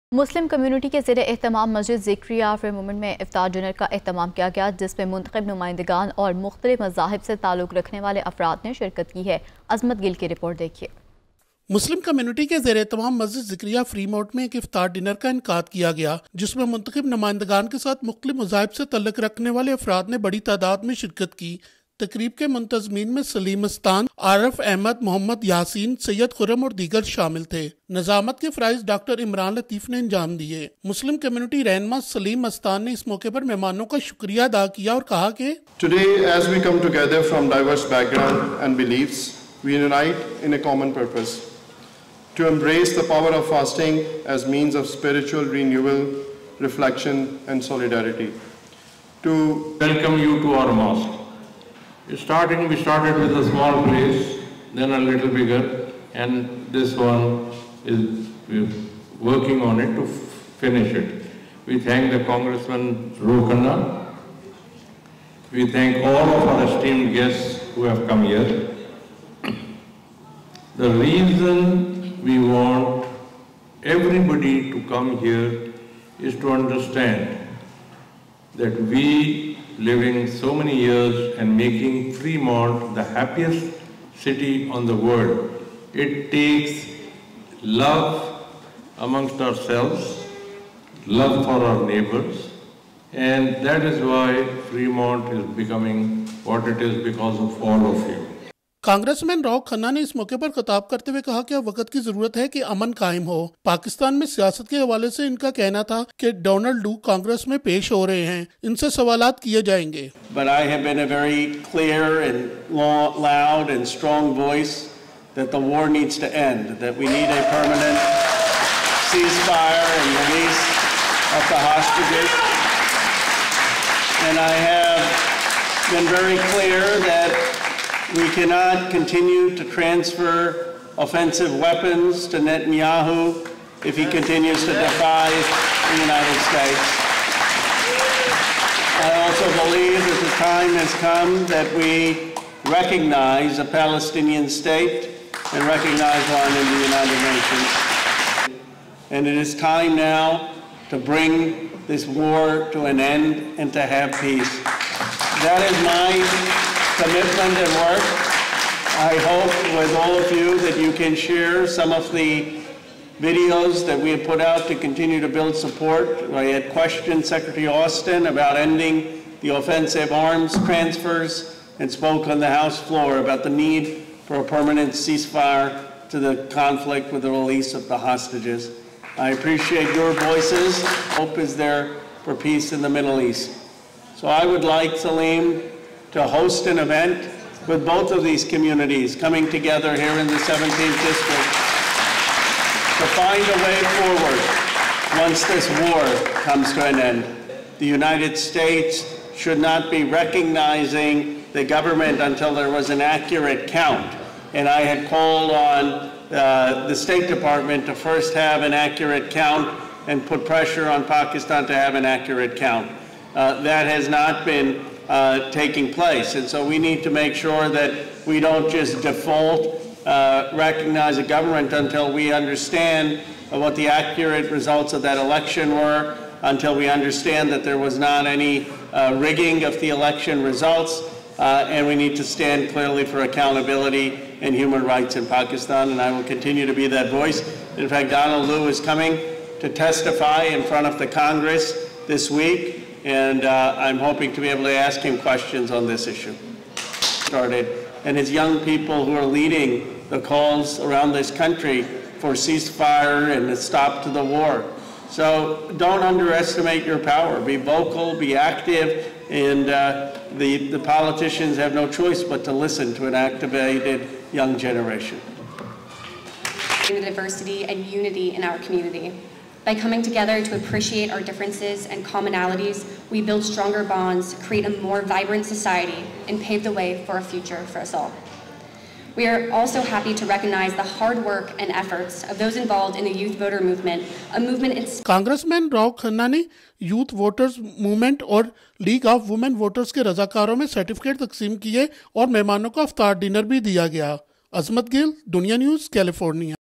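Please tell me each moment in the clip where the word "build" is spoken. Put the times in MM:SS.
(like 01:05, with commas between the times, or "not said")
02:45, 04:33.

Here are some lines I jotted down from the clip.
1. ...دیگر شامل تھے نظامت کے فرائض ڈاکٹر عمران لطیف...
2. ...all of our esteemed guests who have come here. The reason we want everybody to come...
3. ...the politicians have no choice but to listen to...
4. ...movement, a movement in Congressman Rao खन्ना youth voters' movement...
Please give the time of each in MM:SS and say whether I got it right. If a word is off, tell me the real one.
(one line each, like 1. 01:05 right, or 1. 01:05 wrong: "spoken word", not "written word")
1. 00:26 right
2. 01:06 right
3. 04:20 right
4. 04:43 right.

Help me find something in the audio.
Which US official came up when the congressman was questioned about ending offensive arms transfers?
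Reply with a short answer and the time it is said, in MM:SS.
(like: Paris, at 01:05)
Secretary Austin, at 02:47.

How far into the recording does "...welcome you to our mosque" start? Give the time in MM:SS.
00:49.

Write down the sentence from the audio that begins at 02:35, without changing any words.
That is my commitment and work.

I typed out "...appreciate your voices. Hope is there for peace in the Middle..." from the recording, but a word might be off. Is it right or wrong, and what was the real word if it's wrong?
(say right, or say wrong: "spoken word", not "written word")
right.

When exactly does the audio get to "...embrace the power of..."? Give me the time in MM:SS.
00:42.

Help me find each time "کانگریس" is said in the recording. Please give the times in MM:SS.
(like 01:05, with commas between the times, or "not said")
01:38, 01:47.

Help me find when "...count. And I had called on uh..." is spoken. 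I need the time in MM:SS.
03:23.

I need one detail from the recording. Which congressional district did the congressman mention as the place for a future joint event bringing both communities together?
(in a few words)
17th district.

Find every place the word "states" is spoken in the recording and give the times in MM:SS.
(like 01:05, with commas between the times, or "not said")
02:16, 02:24, 03:18, 03:26.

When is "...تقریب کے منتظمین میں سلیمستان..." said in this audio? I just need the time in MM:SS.
00:22.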